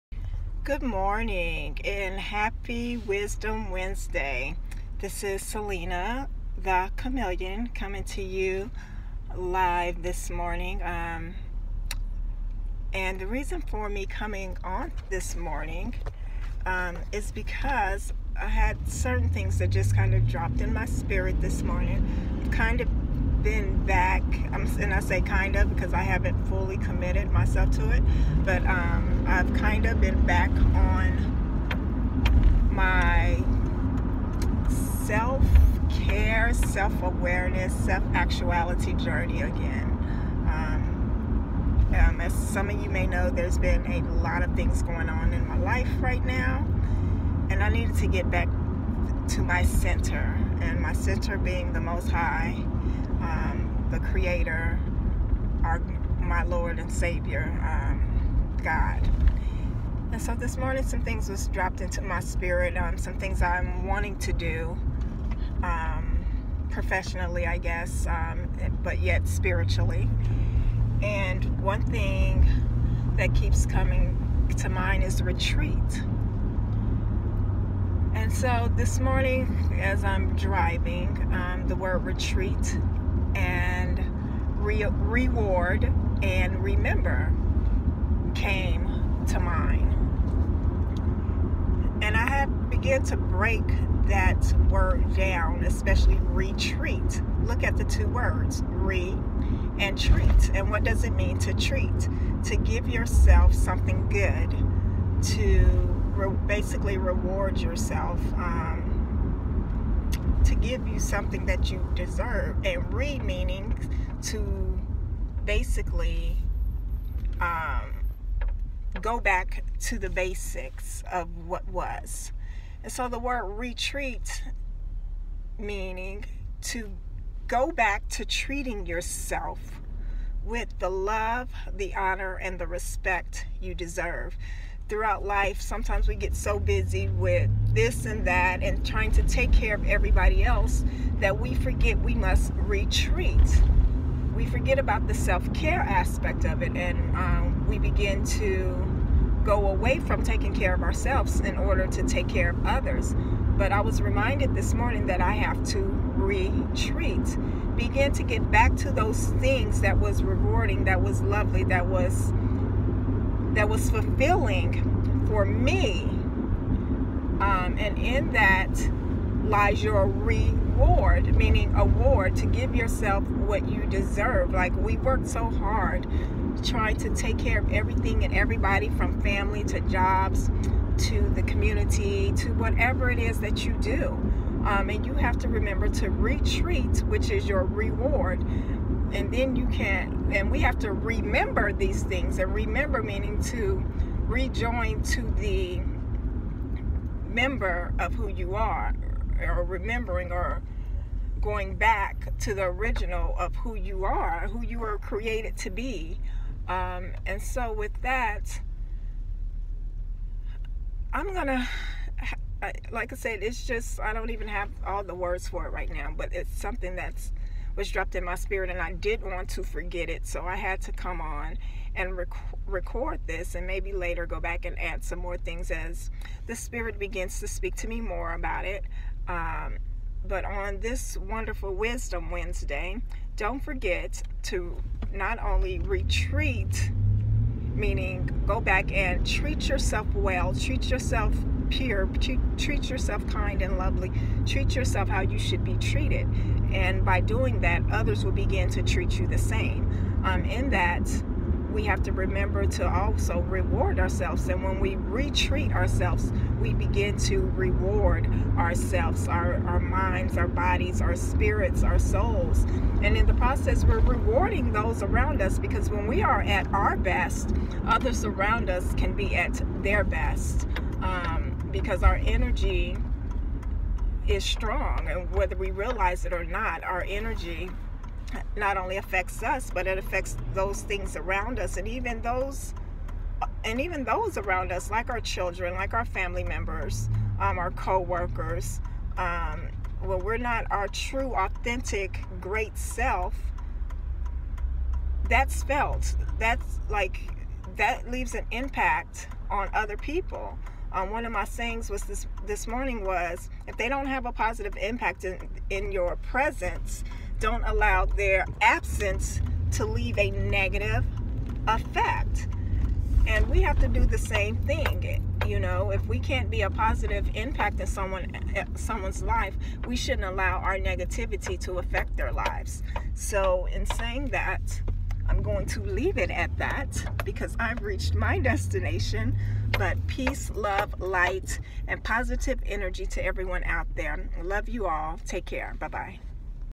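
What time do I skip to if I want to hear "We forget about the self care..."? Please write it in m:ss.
2:24.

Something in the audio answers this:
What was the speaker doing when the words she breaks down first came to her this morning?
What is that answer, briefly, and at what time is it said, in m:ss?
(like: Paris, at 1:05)
Driving, at 1:20.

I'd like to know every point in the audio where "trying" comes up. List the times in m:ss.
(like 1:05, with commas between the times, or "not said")
2:18, 2:56.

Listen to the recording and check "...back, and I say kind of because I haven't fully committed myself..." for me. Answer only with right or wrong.
right.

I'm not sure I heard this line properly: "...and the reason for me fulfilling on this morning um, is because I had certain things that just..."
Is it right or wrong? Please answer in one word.
wrong.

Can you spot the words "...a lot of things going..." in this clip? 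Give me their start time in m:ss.
0:43.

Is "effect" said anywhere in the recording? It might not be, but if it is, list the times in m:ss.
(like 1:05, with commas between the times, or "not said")
5:11.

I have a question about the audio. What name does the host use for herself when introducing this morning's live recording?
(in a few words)
Selena the Chameleon.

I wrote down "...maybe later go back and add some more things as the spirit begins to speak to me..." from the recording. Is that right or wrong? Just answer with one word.
right.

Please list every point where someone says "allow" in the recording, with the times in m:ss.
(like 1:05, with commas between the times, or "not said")
5:07, 5:20.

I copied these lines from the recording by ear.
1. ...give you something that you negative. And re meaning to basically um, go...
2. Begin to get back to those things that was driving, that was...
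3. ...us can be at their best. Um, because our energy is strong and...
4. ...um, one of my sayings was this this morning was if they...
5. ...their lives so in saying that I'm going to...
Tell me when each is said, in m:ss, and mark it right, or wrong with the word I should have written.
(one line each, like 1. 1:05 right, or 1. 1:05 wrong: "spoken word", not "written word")
1. 1:50 wrong: "deserve", not "negative"
2. 2:37 wrong: "rewarding", not "driving"
3. 4:28 right
4. 5:00 right
5. 5:22 right.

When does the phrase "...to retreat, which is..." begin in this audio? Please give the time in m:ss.
3:05.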